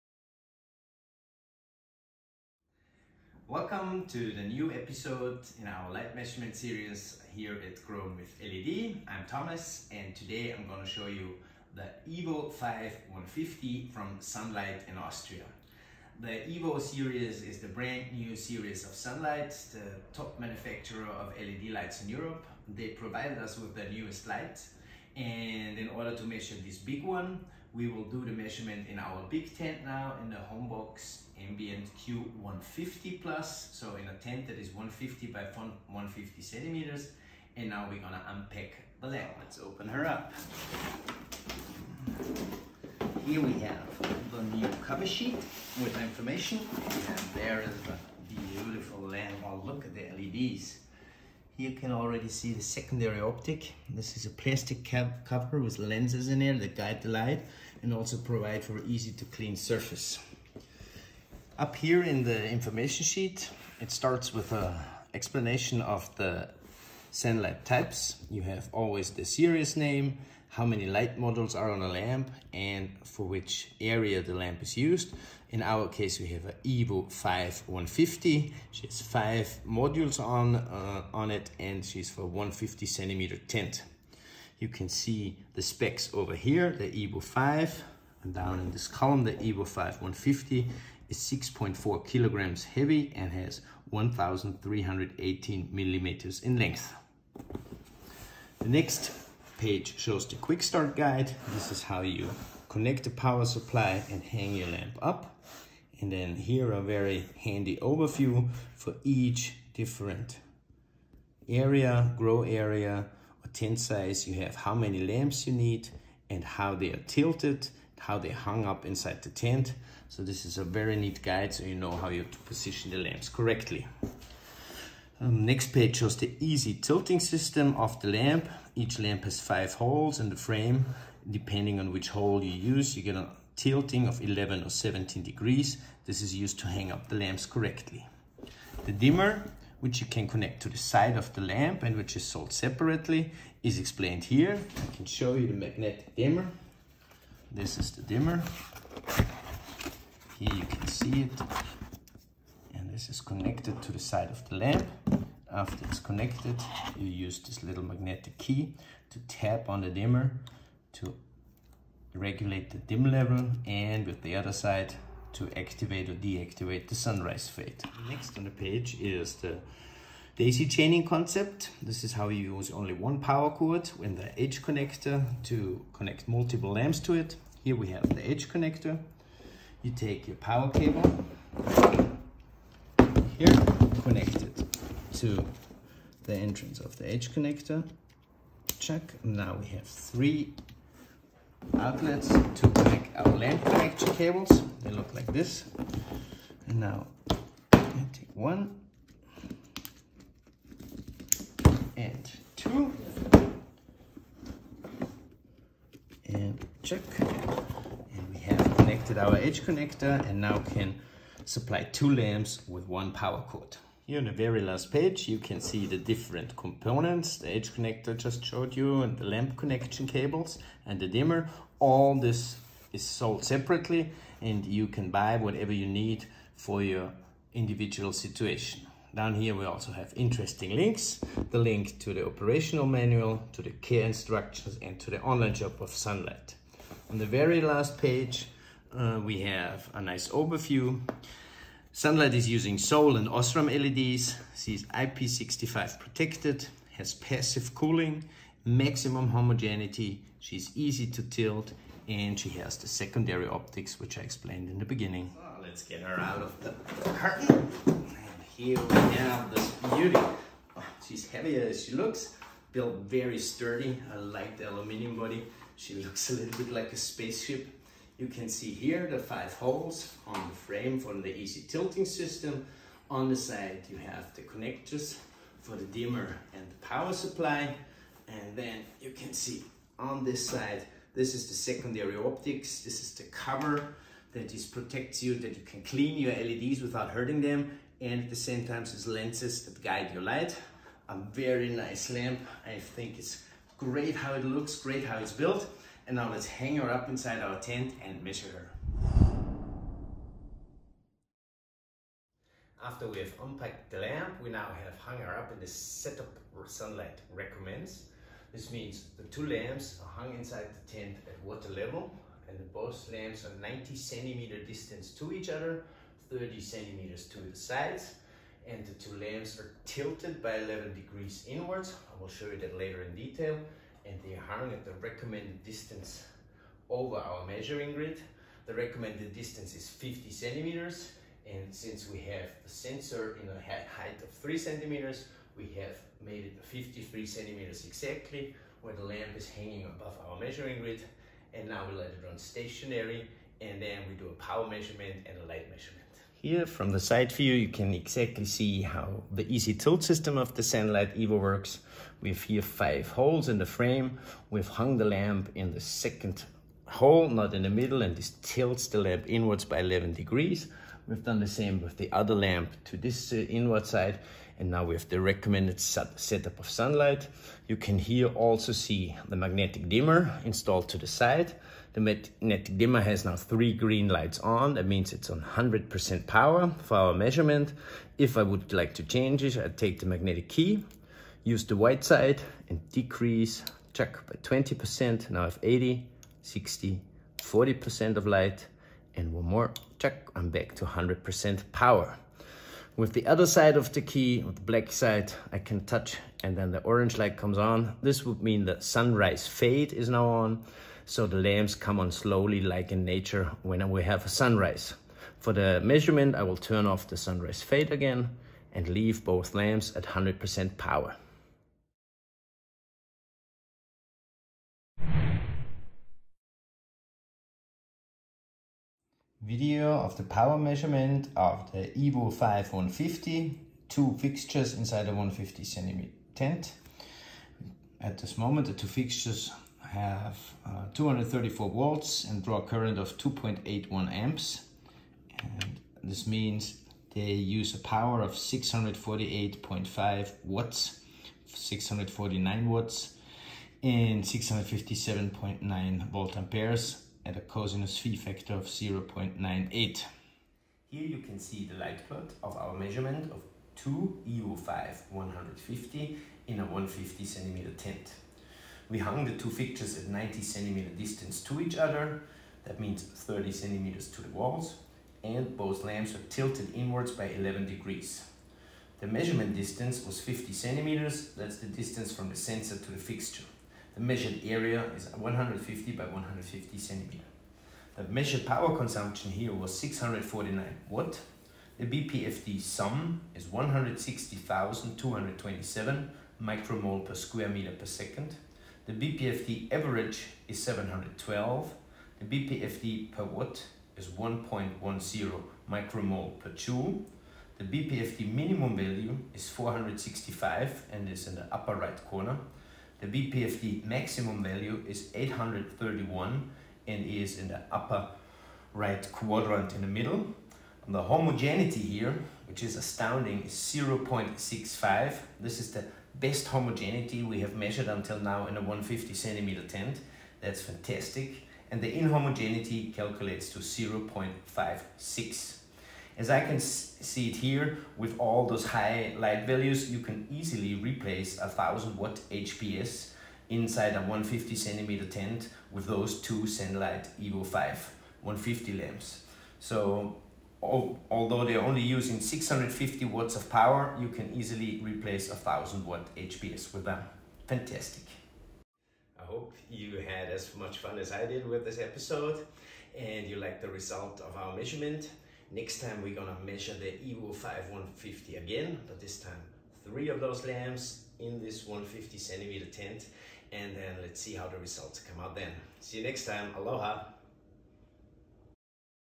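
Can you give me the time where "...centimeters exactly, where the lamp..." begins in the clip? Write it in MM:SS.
05:37.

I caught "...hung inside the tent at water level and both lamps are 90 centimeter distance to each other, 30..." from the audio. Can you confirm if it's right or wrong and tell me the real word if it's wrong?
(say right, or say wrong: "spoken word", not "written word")
right.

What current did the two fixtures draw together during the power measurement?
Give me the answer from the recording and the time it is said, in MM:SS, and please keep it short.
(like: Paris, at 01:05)
2.81 amps, at 07:13.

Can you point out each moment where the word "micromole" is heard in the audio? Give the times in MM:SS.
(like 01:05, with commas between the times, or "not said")
08:06, 08:15.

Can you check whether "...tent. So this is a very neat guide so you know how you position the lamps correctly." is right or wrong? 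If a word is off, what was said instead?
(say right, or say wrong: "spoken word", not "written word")
right.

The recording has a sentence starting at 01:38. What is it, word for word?
The next page shows the quick start guide.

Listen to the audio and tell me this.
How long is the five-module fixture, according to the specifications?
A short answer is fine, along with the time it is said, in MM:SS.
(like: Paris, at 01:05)
1,318 millimeters, at 01:33.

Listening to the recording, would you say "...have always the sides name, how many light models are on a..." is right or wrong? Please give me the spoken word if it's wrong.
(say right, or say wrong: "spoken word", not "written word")
wrong: "series", not "sides".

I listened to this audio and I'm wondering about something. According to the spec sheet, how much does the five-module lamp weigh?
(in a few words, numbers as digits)
6.4 kilograms.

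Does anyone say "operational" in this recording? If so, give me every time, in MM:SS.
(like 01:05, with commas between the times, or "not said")
03:52.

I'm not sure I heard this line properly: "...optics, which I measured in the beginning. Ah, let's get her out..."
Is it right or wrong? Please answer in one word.
wrong.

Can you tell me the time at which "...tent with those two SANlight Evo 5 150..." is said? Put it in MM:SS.
08:55.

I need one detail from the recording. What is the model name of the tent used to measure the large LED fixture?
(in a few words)
Homebox Ambient Q150 Plus.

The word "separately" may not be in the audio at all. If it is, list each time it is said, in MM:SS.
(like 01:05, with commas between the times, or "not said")
02:22, 03:43.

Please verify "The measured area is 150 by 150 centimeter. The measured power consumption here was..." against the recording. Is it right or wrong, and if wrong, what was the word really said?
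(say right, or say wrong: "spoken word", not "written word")
right.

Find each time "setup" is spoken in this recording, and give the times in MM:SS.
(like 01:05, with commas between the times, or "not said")
05:05, 06:06.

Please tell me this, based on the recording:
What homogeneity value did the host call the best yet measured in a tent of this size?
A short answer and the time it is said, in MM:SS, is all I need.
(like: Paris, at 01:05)
0.65, at 08:33.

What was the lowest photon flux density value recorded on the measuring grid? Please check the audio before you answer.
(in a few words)
465.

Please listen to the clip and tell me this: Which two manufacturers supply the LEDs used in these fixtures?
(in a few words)
Seoul and Osram.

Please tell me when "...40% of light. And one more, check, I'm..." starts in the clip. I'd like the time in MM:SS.
06:27.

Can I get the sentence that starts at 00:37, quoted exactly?
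And now we're gonna unpack the lamp.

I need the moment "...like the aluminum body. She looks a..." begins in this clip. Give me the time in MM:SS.
04:24.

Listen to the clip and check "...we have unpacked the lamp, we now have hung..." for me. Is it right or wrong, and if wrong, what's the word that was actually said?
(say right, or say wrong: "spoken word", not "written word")
right.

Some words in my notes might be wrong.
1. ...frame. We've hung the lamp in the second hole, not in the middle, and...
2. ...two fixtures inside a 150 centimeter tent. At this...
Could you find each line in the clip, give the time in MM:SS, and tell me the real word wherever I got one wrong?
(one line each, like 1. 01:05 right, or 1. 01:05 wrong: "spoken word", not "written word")
1. 05:53 right
2. 07:03 right.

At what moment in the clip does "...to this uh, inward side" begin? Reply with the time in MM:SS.
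06:02.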